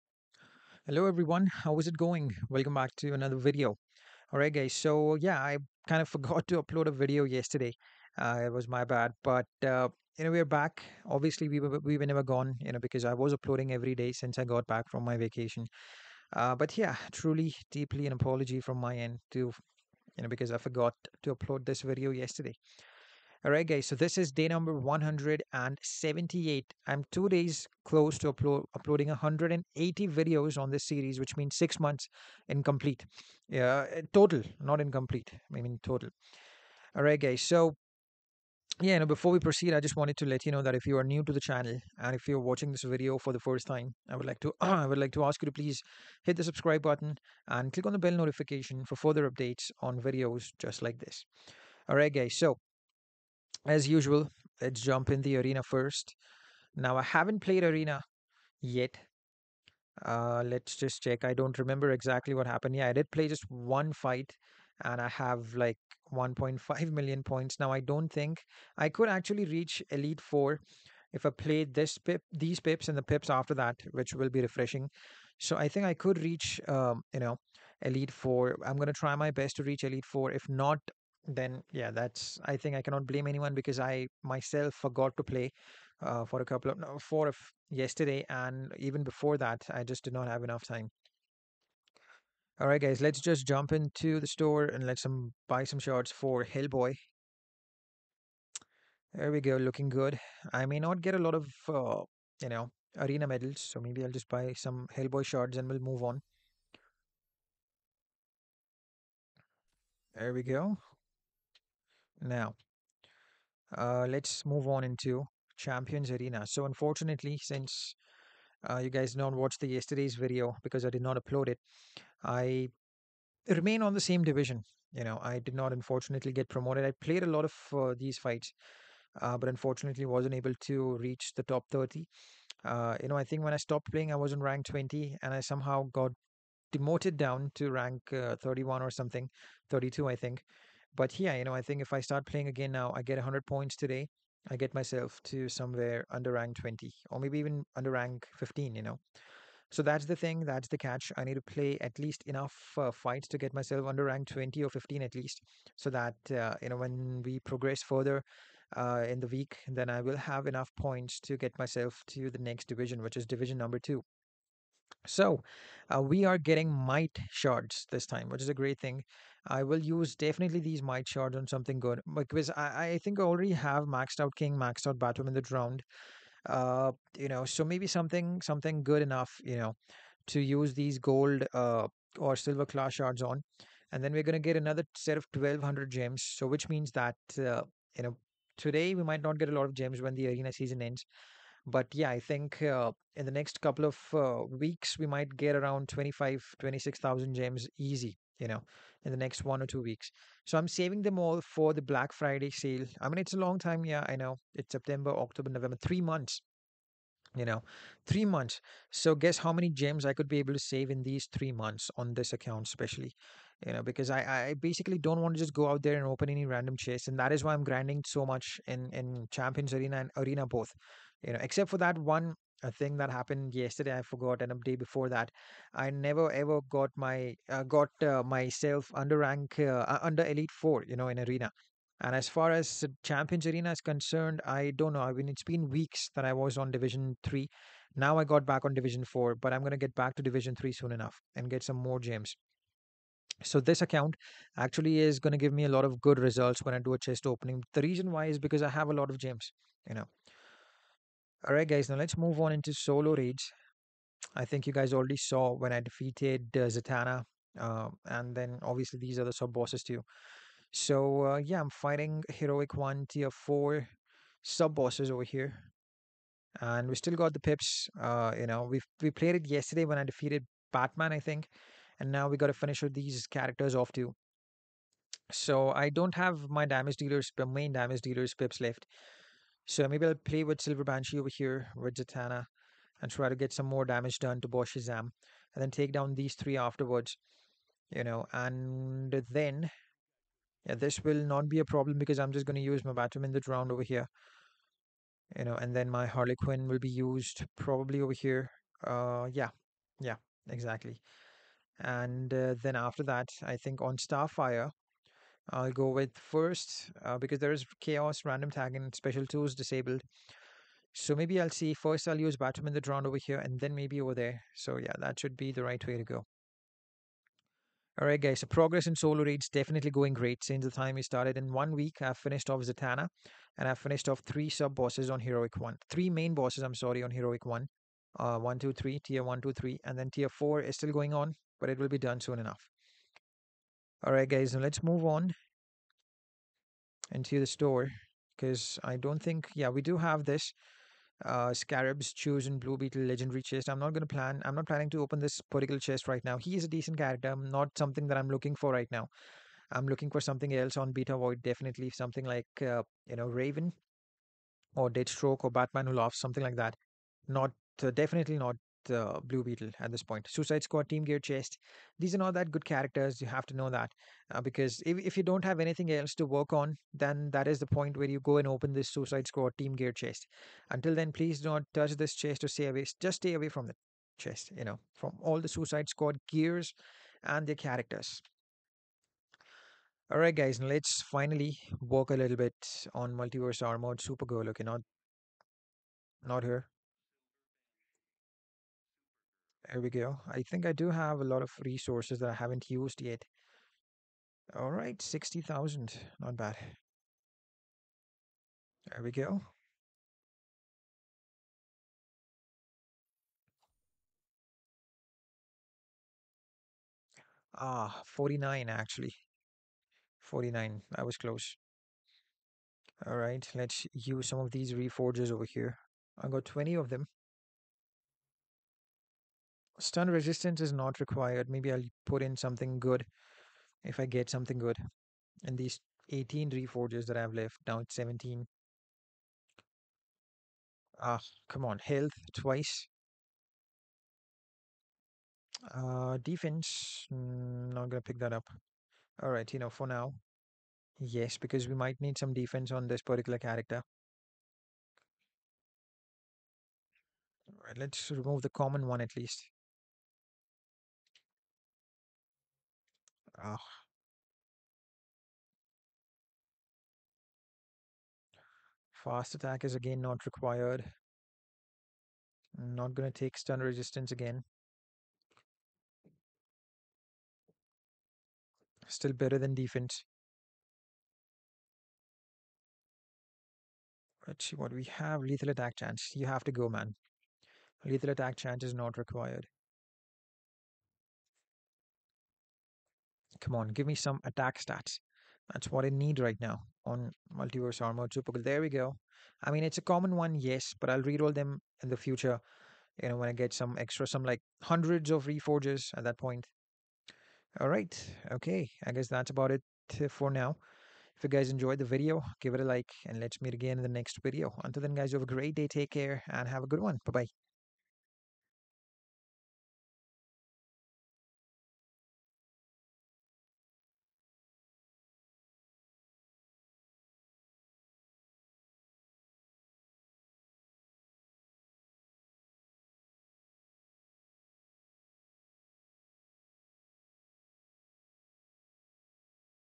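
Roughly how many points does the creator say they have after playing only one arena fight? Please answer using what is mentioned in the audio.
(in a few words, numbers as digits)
1.5 million.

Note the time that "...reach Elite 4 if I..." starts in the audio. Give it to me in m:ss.
1:09.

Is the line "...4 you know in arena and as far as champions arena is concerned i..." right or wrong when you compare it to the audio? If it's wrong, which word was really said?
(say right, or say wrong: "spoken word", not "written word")
right.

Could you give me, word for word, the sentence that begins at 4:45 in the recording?
And then take down these three afterwards.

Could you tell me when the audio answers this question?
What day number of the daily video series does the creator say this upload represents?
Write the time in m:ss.
0:24.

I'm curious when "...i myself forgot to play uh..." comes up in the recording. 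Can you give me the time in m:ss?
1:23.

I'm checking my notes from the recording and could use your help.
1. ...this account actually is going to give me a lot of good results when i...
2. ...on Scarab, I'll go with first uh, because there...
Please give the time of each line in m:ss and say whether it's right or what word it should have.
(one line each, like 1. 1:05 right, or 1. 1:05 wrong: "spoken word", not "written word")
1. 4:03 right
2. 5:03 wrong: "Starfire", not "Scarab".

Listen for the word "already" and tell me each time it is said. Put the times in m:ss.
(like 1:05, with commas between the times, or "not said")
2:53, 4:14.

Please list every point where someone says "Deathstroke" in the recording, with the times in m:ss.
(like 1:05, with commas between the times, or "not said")
5:54.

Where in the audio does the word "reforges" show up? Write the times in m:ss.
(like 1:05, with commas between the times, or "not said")
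6:54, 7:06, 8:15.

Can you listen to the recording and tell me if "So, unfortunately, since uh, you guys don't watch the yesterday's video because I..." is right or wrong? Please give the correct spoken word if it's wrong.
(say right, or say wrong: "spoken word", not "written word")
right.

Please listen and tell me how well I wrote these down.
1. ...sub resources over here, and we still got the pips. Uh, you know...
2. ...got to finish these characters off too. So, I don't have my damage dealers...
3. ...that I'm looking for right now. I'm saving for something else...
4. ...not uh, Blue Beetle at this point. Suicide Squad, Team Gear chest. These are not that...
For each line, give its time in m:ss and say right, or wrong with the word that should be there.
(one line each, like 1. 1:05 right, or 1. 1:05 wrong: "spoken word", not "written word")
1. 4:24 wrong: "bosses", not "resources"
2. 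4:32 right
3. 5:48 wrong: "looking", not "saving"
4. 5:58 right.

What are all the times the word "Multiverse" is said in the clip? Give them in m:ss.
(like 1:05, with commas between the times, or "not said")
6:23, 8:07.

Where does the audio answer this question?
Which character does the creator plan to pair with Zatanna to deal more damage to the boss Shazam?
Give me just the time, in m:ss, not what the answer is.
4:40.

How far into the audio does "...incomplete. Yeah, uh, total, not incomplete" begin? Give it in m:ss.
0:32.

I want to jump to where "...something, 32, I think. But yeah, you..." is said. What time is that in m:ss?
2:18.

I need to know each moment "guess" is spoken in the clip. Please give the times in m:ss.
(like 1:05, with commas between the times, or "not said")
3:29, 8:18.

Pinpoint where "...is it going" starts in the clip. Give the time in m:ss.
0:01.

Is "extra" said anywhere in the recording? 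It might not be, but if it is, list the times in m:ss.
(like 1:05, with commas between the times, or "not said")
8:13.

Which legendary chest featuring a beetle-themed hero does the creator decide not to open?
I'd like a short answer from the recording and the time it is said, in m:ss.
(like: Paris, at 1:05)
Scarab's Chosen Blue Beetle, at 5:41.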